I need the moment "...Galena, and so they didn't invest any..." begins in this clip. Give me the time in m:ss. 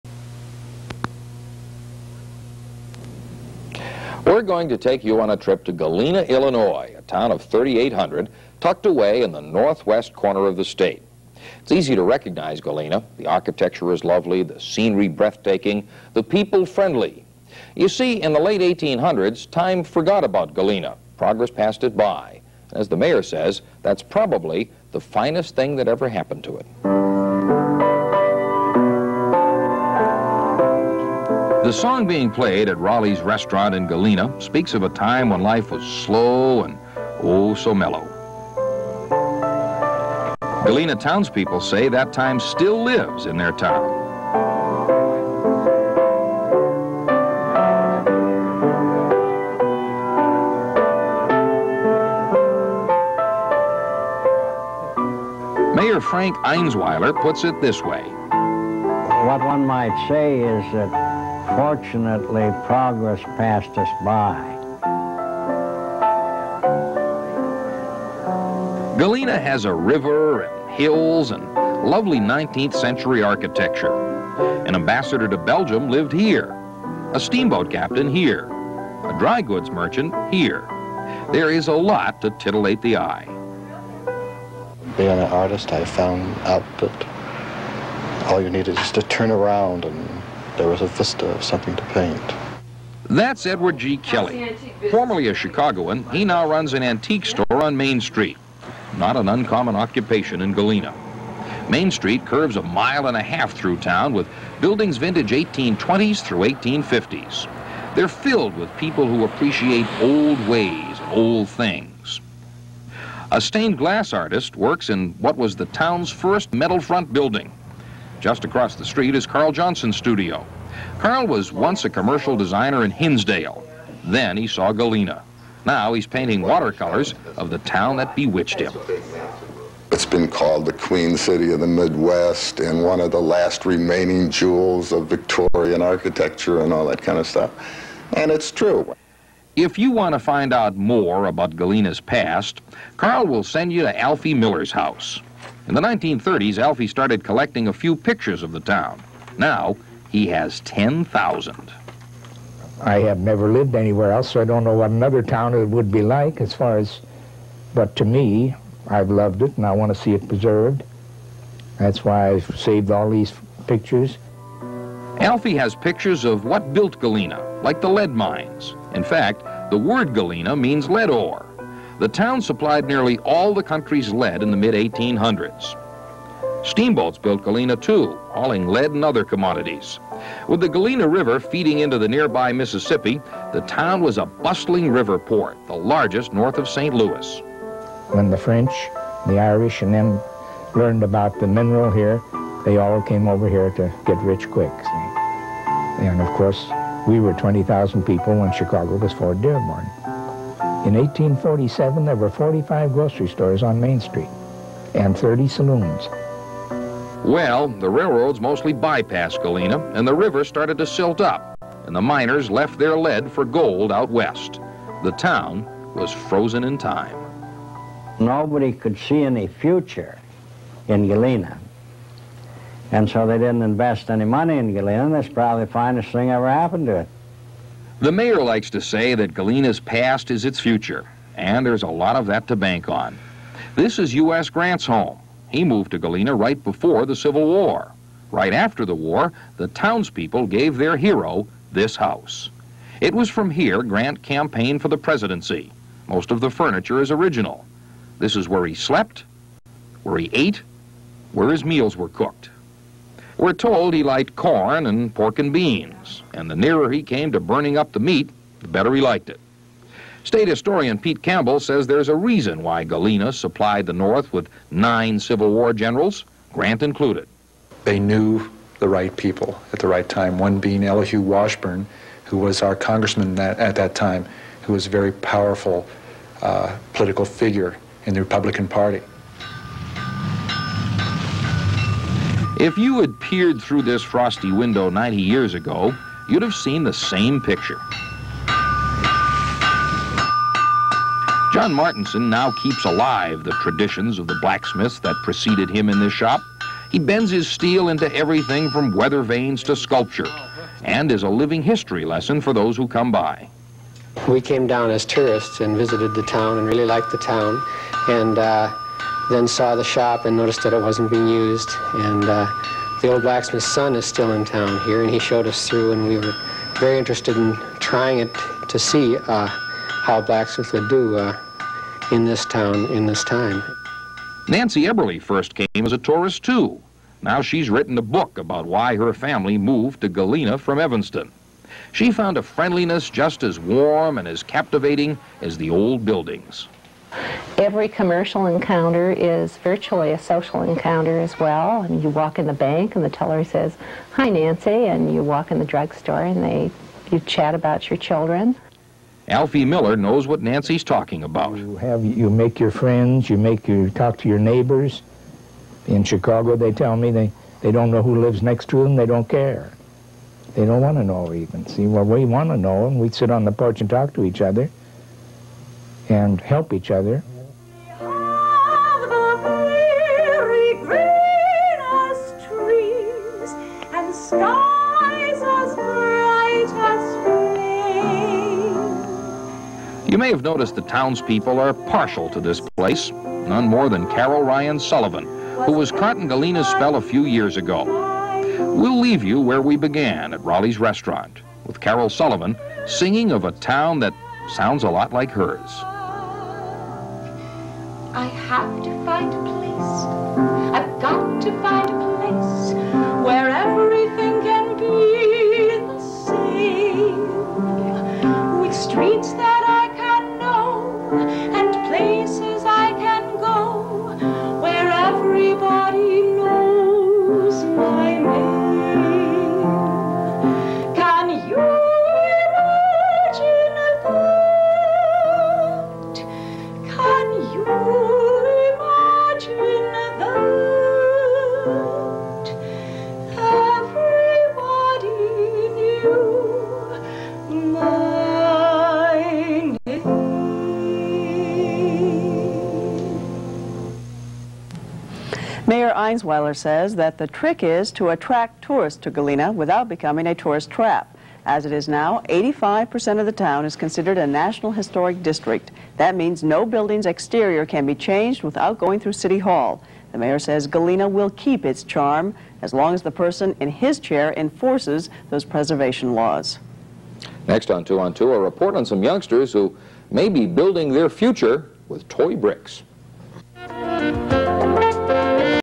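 3:41.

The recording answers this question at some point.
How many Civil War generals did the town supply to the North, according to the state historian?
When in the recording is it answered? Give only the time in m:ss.
4:24.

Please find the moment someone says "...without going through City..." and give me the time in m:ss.
7:38.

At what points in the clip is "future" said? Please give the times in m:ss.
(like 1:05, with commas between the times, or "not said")
3:39, 3:50, 7:51.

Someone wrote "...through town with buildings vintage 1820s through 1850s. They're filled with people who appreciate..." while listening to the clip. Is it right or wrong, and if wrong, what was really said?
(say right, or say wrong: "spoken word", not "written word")
right.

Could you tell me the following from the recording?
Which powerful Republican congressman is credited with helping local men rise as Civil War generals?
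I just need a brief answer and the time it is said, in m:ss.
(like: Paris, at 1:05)
Elihu Washburne, at 4:30.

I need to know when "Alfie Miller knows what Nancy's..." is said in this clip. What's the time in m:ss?
5:49.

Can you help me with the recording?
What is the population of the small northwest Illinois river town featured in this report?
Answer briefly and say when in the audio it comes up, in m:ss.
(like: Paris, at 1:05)
3,800, at 0:07.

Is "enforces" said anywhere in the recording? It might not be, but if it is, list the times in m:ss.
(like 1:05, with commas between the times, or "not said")
7:44.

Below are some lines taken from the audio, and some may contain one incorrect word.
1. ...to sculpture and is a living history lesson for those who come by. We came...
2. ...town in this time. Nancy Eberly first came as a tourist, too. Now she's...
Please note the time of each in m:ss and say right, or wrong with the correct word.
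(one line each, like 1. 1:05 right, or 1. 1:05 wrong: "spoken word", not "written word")
1. 4:59 right
2. 5:22 right.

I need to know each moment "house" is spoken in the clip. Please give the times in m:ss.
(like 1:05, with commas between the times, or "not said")
2:24, 4:01.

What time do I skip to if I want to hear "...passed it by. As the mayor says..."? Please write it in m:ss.
0:21.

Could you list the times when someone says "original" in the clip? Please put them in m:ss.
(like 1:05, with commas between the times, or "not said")
4:07.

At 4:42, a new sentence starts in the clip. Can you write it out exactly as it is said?
If you had peered through this frosty window 90 years ago, you'd have seen the same picture.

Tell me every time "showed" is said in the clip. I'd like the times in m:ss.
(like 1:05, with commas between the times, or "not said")
5:15.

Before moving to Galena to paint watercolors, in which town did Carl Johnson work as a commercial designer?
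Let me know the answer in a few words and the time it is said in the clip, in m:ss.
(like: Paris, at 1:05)
Hinsdale, at 2:02.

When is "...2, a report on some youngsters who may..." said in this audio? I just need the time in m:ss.
7:48.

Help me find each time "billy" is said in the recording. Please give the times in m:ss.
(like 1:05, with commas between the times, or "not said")
not said.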